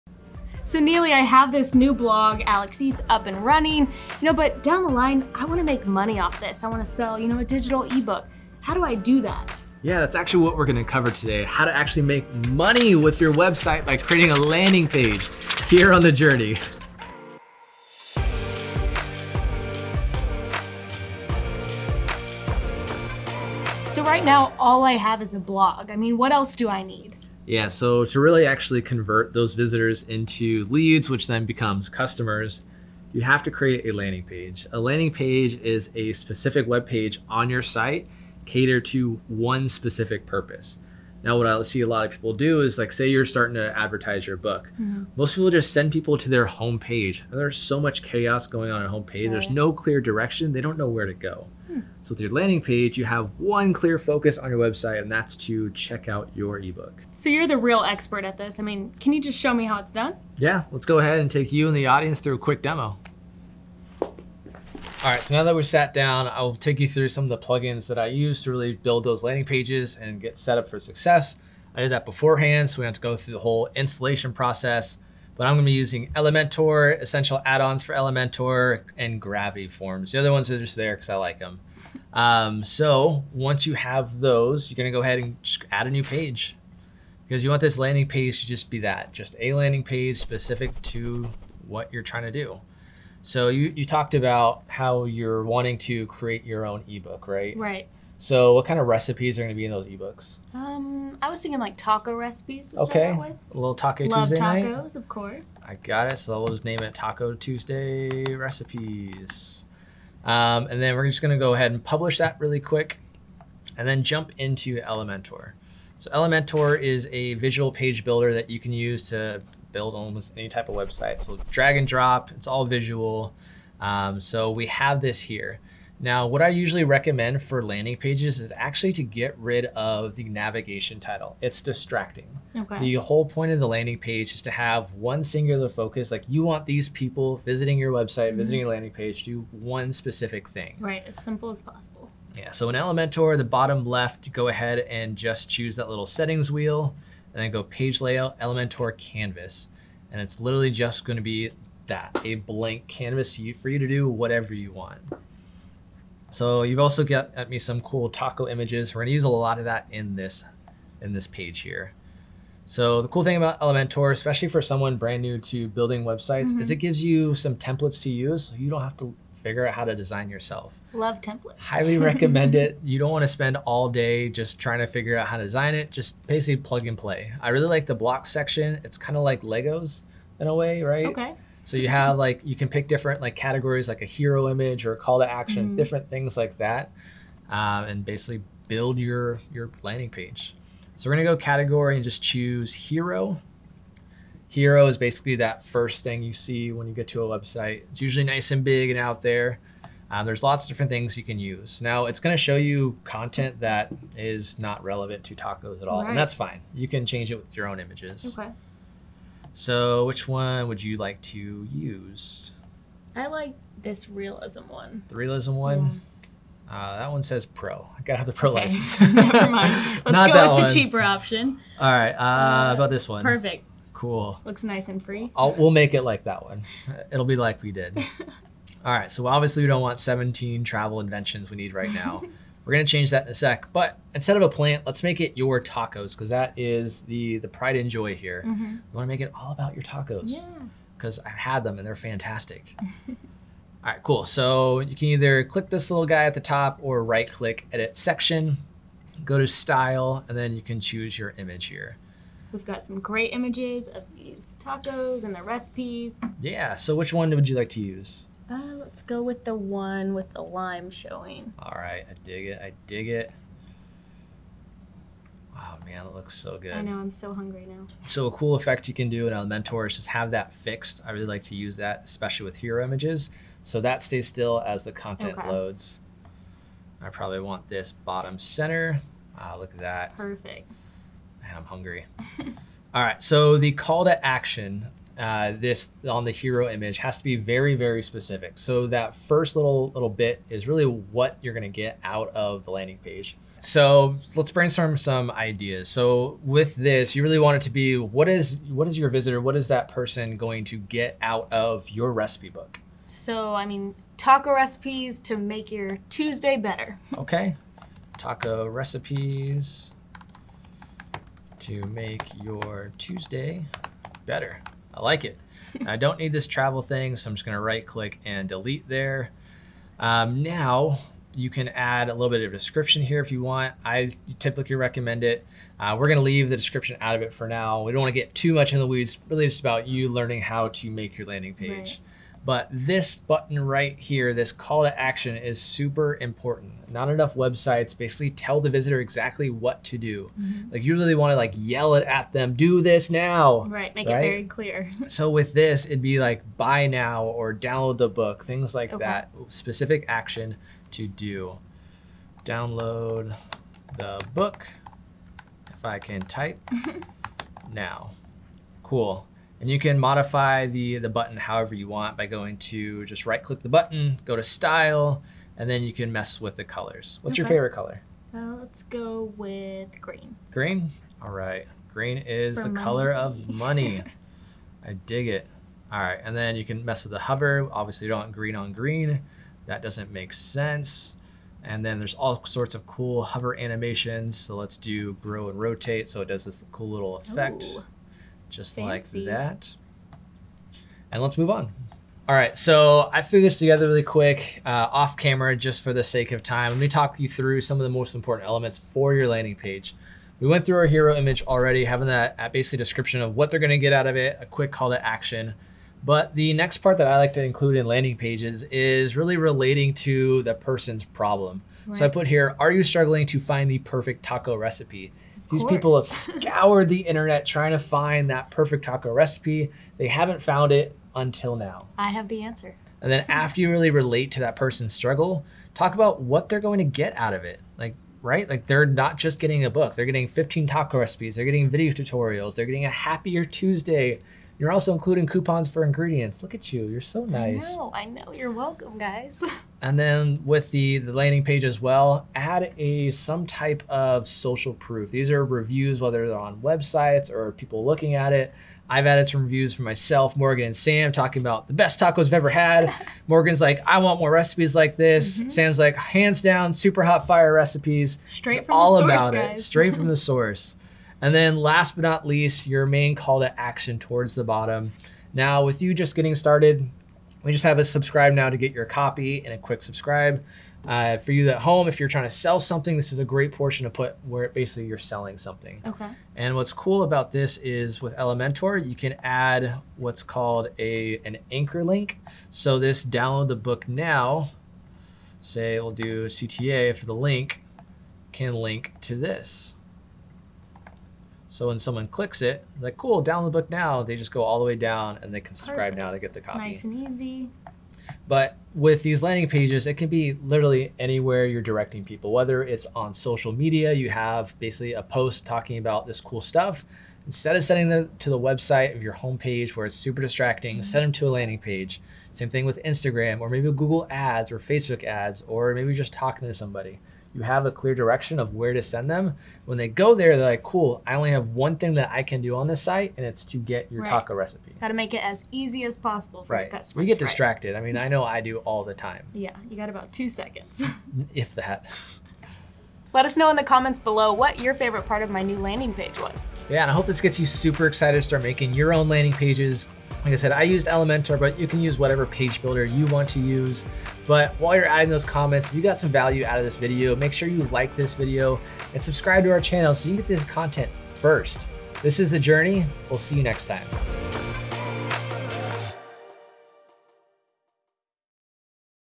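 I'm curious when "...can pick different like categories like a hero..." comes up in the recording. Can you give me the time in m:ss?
3:02.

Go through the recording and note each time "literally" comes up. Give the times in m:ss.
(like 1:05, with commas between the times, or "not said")
2:30, 8:20.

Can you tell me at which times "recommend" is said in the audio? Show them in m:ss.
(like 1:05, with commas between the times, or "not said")
2:06, 2:51, 5:24.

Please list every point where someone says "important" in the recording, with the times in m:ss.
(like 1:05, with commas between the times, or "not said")
5:36, 6:38.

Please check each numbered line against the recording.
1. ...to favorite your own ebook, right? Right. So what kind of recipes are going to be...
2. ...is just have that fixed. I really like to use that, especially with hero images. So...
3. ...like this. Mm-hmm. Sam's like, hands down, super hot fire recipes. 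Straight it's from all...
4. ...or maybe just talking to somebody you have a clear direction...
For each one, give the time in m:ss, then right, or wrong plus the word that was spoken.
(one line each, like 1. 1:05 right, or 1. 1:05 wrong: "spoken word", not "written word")
1. 1:35 wrong: "create", not "favorite"
2. 4:29 right
3. 7:34 right
4. 8:35 right.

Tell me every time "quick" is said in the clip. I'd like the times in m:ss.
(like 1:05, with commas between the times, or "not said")
1:02, 1:52, 6:34, 6:44, 7:49.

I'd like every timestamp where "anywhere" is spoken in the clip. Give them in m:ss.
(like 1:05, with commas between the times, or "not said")
8:20.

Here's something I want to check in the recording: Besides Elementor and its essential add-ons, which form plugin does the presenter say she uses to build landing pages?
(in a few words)
Gravity Forms.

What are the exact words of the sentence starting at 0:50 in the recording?
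They don't know where to go.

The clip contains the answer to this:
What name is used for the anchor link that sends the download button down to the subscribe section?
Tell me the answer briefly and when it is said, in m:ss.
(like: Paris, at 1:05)
CTA, at 8:06.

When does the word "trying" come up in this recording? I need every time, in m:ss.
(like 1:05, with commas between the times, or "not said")
1:32, 2:54, 6:57, 7:52.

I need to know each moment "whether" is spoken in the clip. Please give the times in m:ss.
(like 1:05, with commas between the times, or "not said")
7:25, 8:22.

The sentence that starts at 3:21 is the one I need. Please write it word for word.
Now, it's going to show you content that is not relevant to tacos at all, all right.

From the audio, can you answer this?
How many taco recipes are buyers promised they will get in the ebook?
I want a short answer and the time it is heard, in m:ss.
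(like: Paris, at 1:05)
15, at 7:10.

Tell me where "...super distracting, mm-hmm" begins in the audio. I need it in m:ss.
8:29.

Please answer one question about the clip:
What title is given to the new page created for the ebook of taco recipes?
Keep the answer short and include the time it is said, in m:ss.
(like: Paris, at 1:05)
Taco Tuesday recipes, at 1:46.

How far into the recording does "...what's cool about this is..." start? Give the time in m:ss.
7:56.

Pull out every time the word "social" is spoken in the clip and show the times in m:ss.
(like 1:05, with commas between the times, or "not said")
7:24, 8:23.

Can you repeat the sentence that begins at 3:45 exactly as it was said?
I'll, we'll make it like that one.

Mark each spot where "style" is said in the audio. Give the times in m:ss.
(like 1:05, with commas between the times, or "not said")
4:09, 6:04.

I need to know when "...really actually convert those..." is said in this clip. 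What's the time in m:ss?
0:28.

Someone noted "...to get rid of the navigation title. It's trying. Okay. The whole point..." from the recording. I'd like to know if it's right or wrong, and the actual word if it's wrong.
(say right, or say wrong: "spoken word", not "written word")
wrong: "distracting", not "trying".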